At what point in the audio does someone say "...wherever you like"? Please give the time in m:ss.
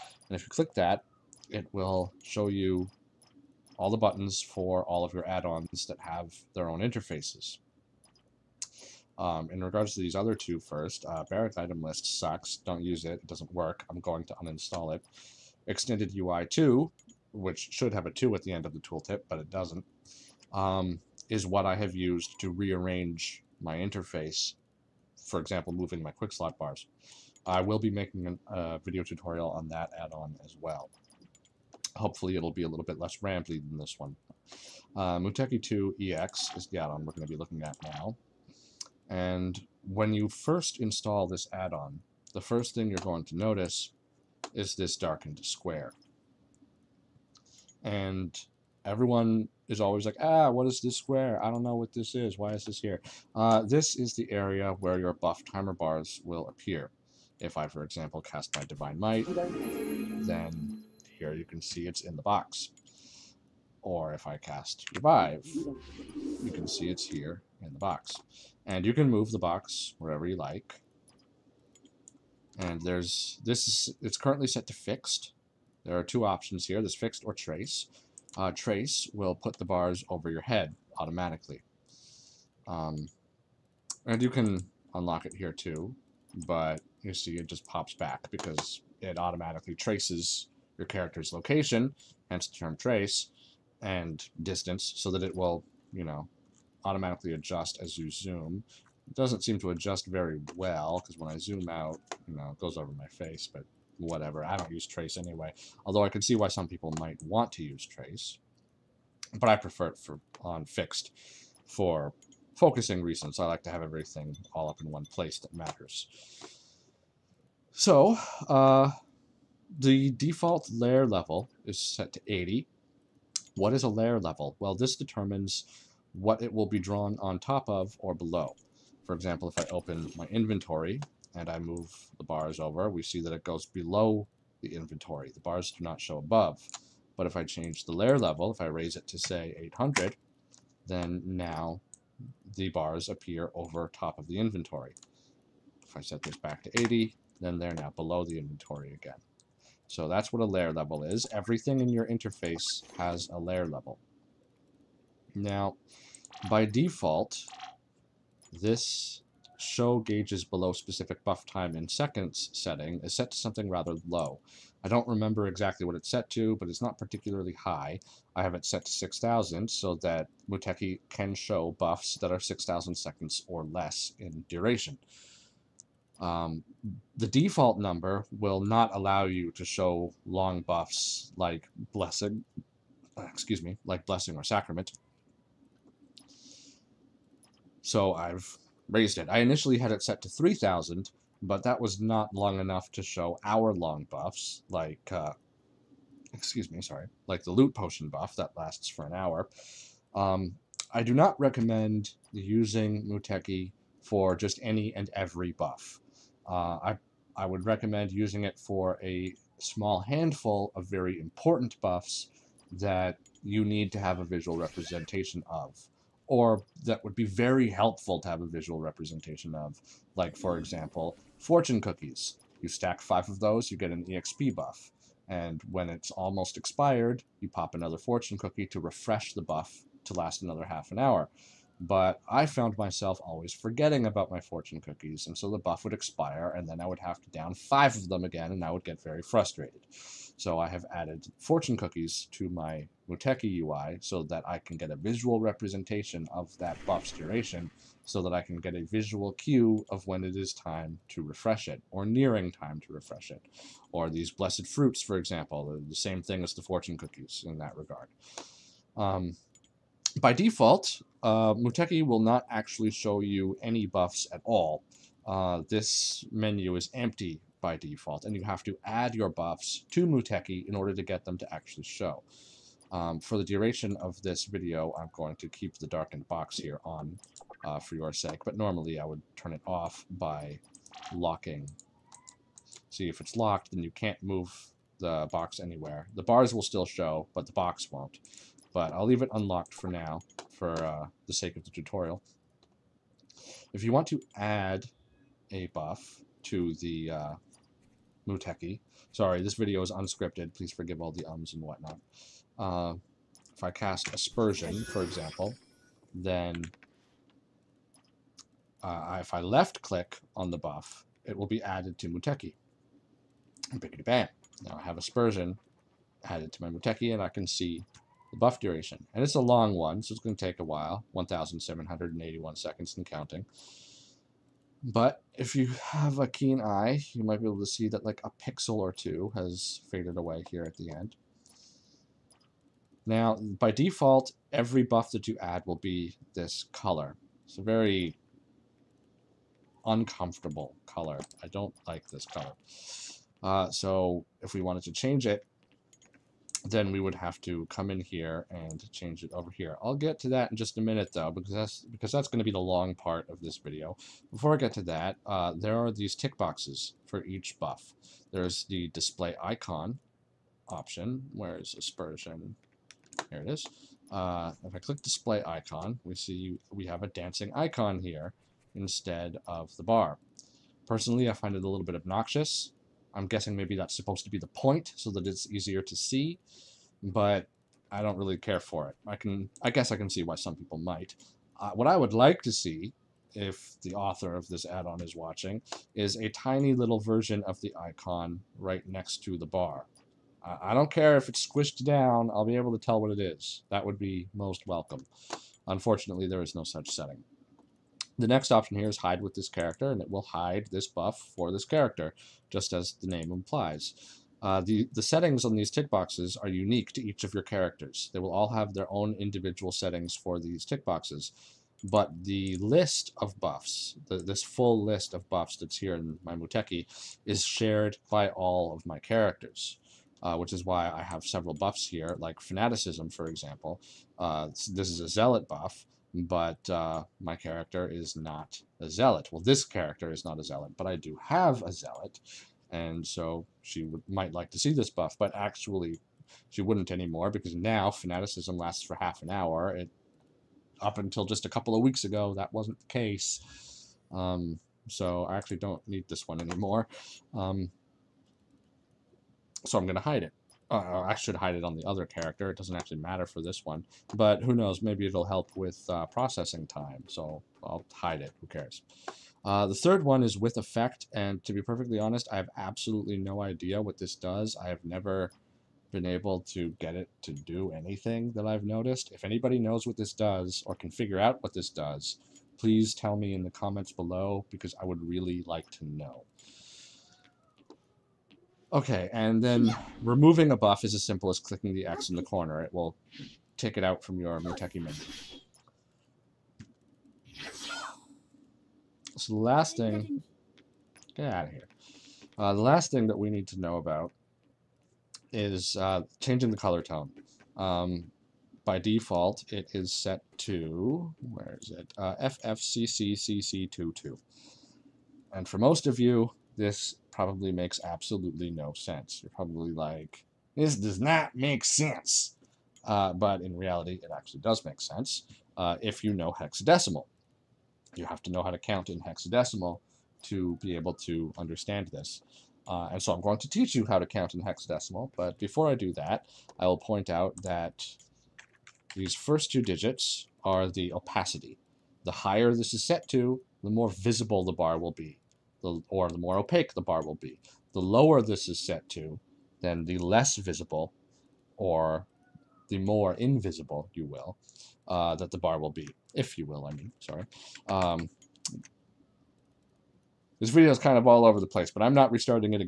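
1:09.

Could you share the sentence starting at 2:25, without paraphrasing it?
If I set this back to 80, then they're now below the inventory again.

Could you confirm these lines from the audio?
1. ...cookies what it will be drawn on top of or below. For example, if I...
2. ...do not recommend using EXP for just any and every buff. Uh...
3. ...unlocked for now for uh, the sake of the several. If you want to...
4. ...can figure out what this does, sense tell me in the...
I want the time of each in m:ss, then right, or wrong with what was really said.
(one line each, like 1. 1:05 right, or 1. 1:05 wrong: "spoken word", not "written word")
1. 2:04 wrong: "determines", not "cookies"
2. 3:21 wrong: "Muteki", not "EXP"
3. 4:49 wrong: "tutorial", not "several"
4. 7:50 wrong: "please", not "sense".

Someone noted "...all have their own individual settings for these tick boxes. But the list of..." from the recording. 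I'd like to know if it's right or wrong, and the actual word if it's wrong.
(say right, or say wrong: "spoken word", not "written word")
right.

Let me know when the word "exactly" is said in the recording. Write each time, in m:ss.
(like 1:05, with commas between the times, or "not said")
2:45.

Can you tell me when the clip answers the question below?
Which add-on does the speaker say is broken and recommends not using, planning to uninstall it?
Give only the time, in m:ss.
0:11.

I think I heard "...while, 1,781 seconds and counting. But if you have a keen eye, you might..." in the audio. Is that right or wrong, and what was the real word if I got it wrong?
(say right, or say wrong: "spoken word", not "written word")
right.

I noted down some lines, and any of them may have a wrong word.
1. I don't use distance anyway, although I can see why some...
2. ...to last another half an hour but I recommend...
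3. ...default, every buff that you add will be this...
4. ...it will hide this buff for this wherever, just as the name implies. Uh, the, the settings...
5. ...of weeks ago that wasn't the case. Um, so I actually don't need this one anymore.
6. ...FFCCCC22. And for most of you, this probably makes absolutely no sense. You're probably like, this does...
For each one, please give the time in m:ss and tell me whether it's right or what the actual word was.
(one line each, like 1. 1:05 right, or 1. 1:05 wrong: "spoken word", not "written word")
1. 1:44 wrong: "trace", not "distance"
2. 3:50 wrong: "found", not "recommend"
3. 5:33 right
4. 6:40 wrong: "character", not "wherever"
5. 7:21 right
6. 8:22 right.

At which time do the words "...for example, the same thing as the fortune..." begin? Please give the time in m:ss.
4:15.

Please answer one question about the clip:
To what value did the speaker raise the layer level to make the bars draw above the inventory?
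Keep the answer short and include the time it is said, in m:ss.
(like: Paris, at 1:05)
800, at 2:19.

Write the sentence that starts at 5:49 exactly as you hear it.
I'll get to that in just a minute though, because that's because that's going to be the long part of this video.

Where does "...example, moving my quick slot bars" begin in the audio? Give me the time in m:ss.
0:25.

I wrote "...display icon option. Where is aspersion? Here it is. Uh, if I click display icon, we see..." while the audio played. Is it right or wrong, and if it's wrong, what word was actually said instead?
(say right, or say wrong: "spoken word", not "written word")
right.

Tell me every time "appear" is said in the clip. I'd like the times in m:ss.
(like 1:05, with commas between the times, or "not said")
0:56, 2:23.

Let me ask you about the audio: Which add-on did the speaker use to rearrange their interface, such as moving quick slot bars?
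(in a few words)
Extended UI 2.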